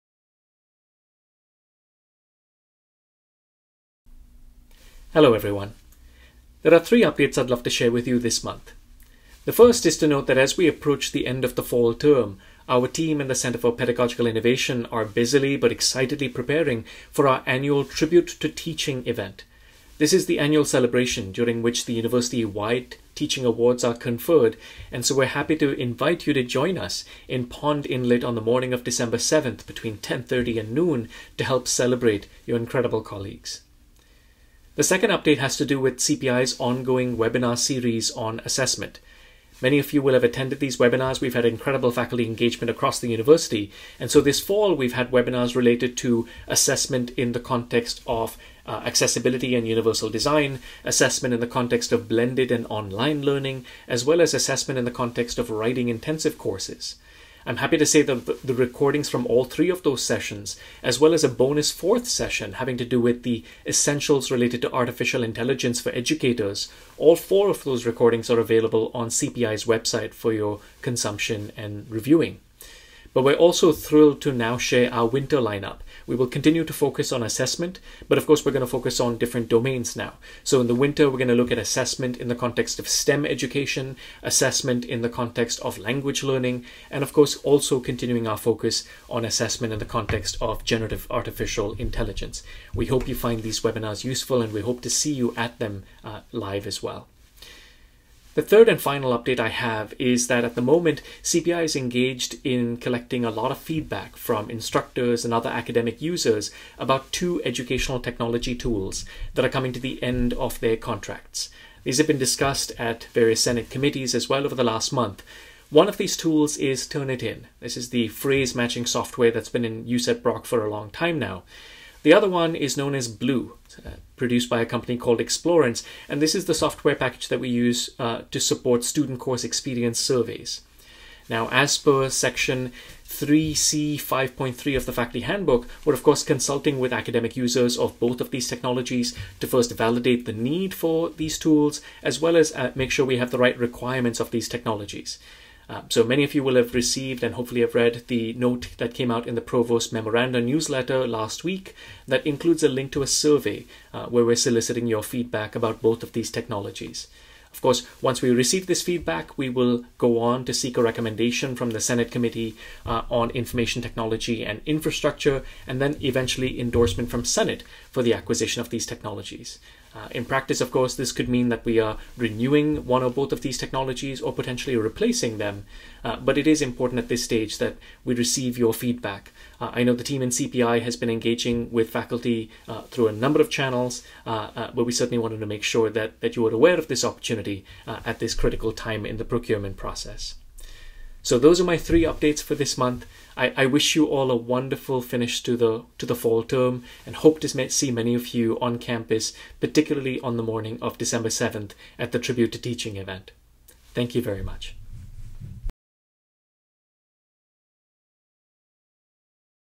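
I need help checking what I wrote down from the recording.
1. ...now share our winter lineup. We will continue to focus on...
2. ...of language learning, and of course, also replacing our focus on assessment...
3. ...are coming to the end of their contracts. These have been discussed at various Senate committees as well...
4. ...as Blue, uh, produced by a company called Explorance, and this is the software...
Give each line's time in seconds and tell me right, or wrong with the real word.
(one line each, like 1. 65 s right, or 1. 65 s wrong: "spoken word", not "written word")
1. 74 s right
2. 85 s wrong: "continuing", not "replacing"
3. 109 s right
4. 122 s right.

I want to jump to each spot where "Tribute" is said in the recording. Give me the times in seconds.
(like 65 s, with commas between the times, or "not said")
17 s, 202 s.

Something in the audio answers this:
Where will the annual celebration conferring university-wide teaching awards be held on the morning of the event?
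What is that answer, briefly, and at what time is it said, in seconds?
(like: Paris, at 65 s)
Pond Inlet, at 27 s.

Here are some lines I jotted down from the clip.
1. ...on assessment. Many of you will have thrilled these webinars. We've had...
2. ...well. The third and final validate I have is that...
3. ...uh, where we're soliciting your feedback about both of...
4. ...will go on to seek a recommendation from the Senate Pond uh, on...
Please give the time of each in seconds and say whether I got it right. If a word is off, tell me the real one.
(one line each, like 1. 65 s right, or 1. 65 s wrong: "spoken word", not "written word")
1. 38 s wrong: "attended", not "thrilled"
2. 96 s wrong: "update", not "validate"
3. 153 s right
4. 159 s wrong: "Committee", not "Pond".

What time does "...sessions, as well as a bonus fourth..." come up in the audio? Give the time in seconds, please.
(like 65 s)
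60 s.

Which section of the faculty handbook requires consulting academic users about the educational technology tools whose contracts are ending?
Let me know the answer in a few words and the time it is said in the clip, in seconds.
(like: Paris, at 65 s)
3C 5.3, at 133 s.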